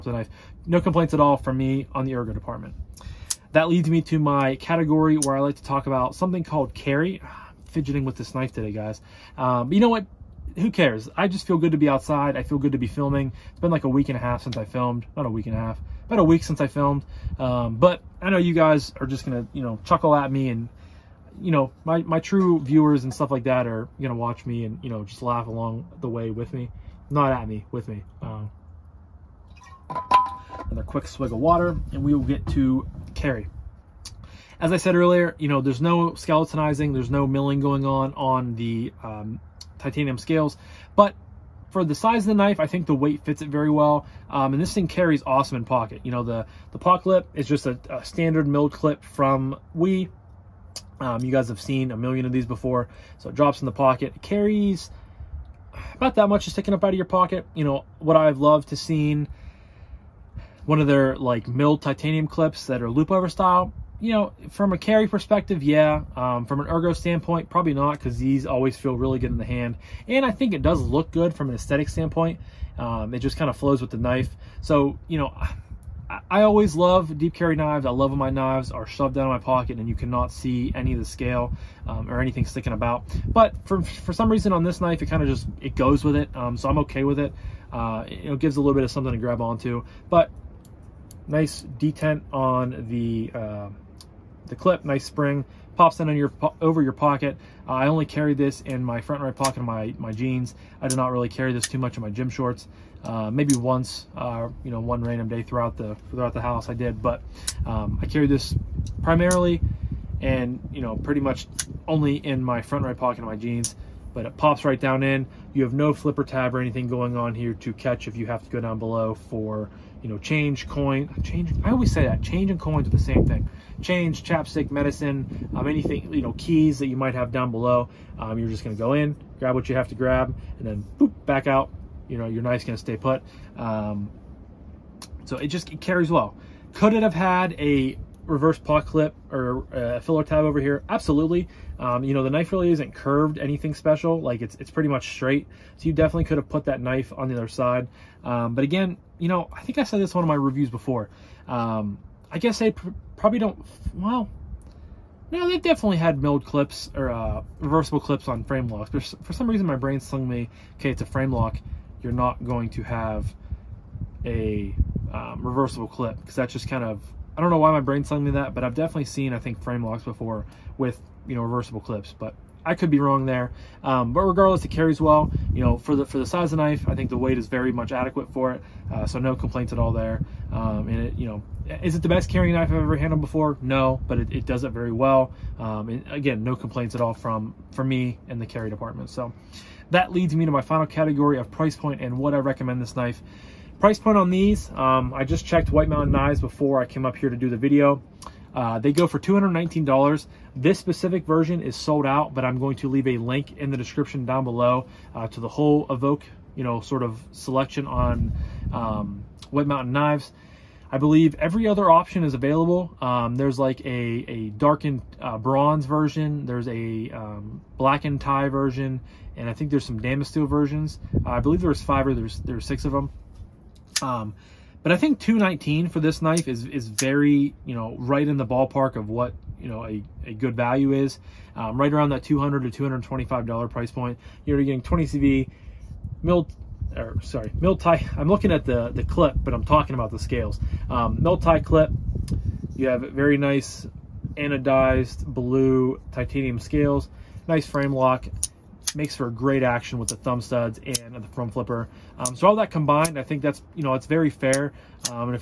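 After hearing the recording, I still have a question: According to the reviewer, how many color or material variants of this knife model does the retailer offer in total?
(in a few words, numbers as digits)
6.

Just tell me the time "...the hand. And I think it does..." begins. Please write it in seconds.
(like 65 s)
69 s.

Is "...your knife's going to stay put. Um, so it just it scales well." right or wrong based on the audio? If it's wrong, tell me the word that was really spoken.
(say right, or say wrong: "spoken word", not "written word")
wrong: "carries", not "scales".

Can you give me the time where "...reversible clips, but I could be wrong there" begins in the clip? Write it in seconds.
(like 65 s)
171 s.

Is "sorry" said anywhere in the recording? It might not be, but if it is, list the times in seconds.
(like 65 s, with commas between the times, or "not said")
237 s.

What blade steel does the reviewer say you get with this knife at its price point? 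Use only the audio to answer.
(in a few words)
20CV.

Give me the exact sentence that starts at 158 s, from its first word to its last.
But for some reason, my brain slung me, okay, it's a frame lock.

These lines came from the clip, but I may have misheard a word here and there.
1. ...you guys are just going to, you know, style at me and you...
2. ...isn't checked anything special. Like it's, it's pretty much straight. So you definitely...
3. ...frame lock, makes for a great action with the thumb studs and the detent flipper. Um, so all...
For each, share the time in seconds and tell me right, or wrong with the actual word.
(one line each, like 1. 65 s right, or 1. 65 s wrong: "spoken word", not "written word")
1. 18 s wrong: "chuckle", not "style"
2. 142 s wrong: "curved", not "checked"
3. 247 s wrong: "front", not "detent".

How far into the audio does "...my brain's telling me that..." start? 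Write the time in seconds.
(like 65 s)
167 s.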